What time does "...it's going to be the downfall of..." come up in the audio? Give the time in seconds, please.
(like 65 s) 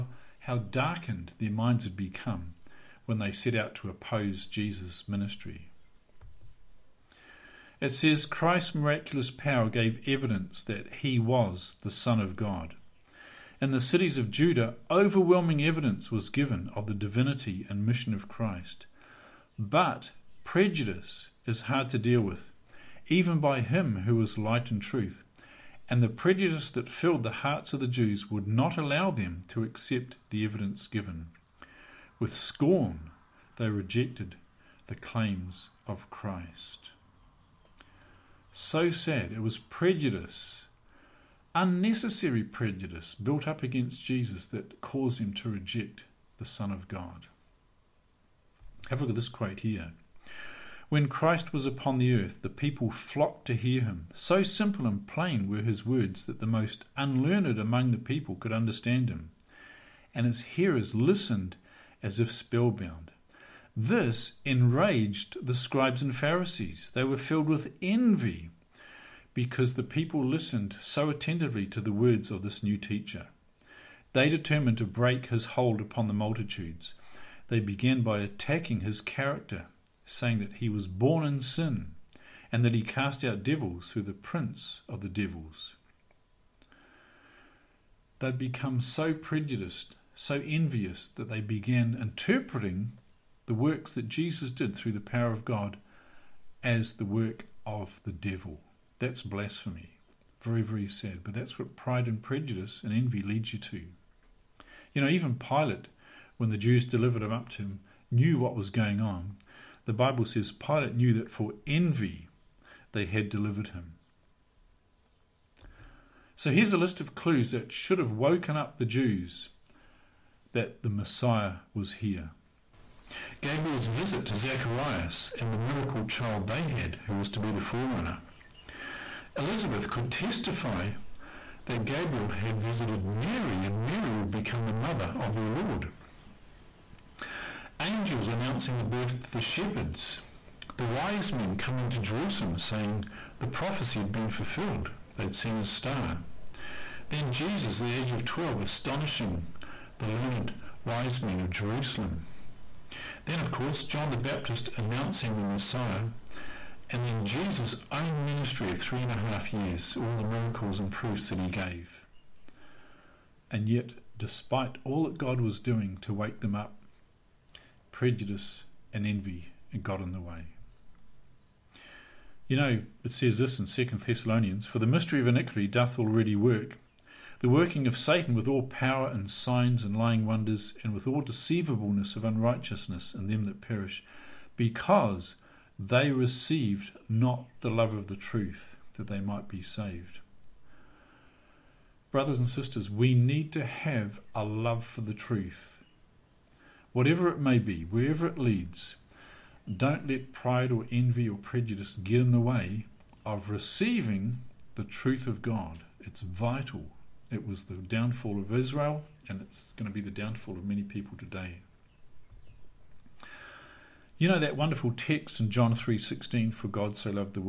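209 s.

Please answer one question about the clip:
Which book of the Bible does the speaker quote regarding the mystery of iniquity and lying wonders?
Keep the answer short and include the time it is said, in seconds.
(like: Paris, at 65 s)
Second Thessalonians, at 173 s.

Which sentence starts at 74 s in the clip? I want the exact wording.
They determined to break his hold upon the multitudes.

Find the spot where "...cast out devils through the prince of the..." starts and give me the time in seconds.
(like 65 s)
82 s.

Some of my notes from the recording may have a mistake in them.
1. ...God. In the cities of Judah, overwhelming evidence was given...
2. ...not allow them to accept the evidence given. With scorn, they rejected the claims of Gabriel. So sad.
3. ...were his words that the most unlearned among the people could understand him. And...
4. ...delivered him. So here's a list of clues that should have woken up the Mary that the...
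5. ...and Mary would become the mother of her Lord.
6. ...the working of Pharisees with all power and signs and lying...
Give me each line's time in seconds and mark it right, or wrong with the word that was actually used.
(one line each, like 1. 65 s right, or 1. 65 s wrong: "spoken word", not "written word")
1. 12 s right
2. 28 s wrong: "Christ", not "Gabriel"
3. 55 s right
4. 113 s wrong: "Jews", not "Mary"
5. 133 s right
6. 177 s wrong: "Satan", not "Pharisees".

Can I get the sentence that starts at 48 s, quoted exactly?
Have a look at this quote here.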